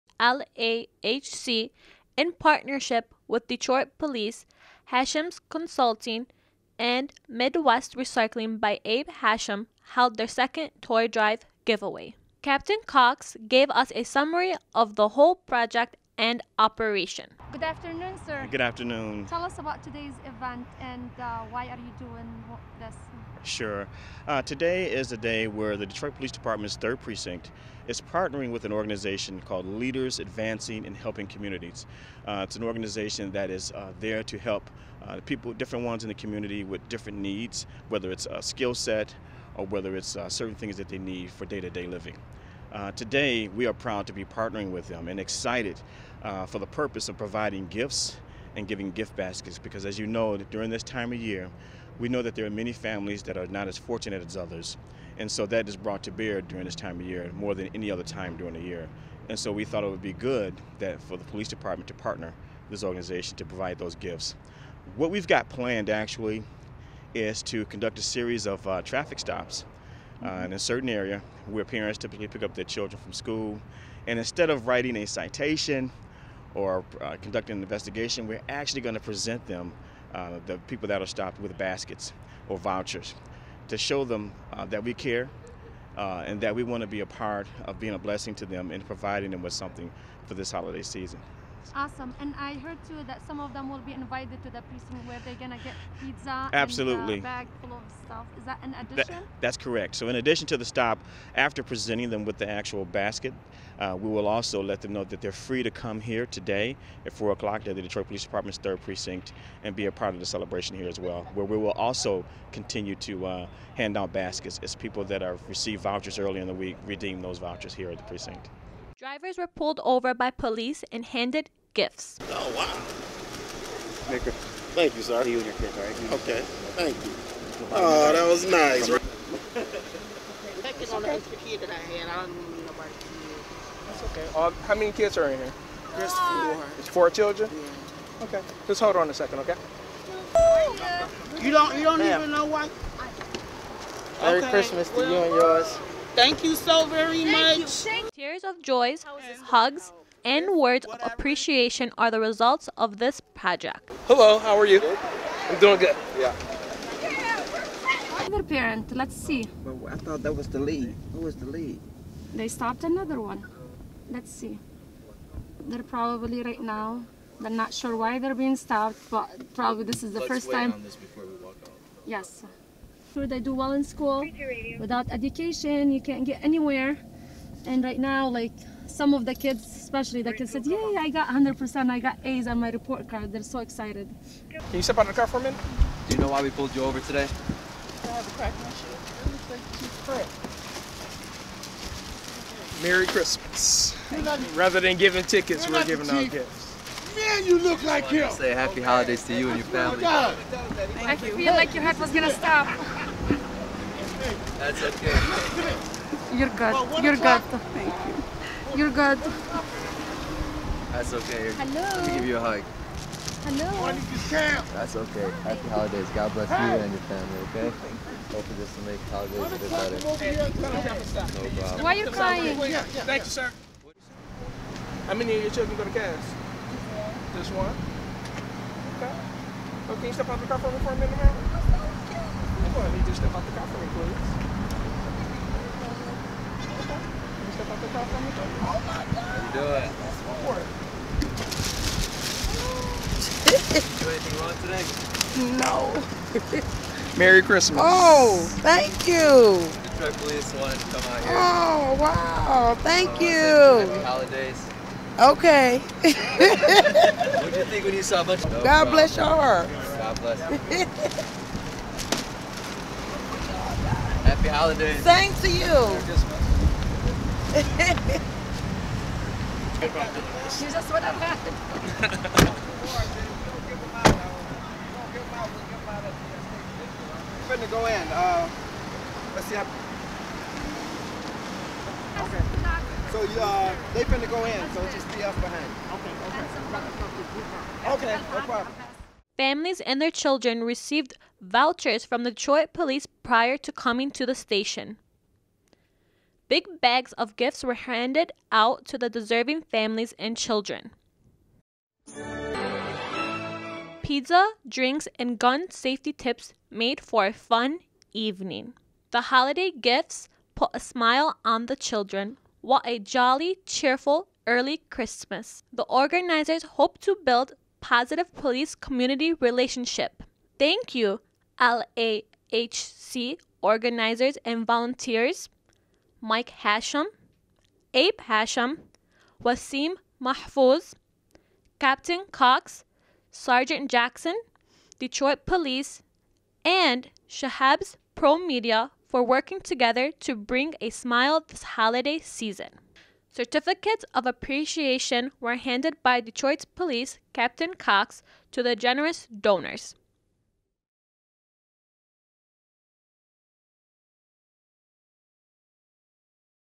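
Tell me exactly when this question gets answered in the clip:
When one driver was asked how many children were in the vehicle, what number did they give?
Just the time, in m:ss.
2:15.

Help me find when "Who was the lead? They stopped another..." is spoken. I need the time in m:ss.
2:41.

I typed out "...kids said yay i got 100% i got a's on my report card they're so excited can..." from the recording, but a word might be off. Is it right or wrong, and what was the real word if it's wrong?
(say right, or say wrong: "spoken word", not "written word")
right.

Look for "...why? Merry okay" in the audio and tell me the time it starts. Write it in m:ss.
2:22.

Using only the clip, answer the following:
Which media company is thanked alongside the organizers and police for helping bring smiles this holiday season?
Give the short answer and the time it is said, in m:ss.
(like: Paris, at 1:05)
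Shehab's Pro Media, at 5:37.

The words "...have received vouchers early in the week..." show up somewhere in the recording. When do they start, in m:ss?
1:55.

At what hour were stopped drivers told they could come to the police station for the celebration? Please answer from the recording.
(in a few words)
4 o'clock.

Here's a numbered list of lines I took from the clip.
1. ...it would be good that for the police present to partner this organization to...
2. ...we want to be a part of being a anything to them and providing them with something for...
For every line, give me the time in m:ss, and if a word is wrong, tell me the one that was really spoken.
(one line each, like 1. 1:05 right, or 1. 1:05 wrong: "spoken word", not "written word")
1. 0:59 wrong: "department", not "present"
2. 1:26 wrong: "blessing", not "anything".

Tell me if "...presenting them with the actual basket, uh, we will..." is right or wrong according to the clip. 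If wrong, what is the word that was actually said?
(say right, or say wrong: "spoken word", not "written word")
right.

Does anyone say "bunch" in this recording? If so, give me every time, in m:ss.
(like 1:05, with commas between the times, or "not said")
4:18.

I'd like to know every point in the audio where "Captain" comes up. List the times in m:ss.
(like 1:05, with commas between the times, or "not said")
0:12, 5:31, 5:47.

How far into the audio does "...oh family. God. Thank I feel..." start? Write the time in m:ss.
3:19.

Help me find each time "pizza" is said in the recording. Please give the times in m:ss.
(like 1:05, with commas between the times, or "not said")
1:35, 5:04.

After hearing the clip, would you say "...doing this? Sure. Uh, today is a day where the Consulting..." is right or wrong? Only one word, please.
wrong.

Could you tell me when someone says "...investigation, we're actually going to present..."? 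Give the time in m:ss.
1:17.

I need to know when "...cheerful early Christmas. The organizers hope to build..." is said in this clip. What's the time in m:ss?
5:13.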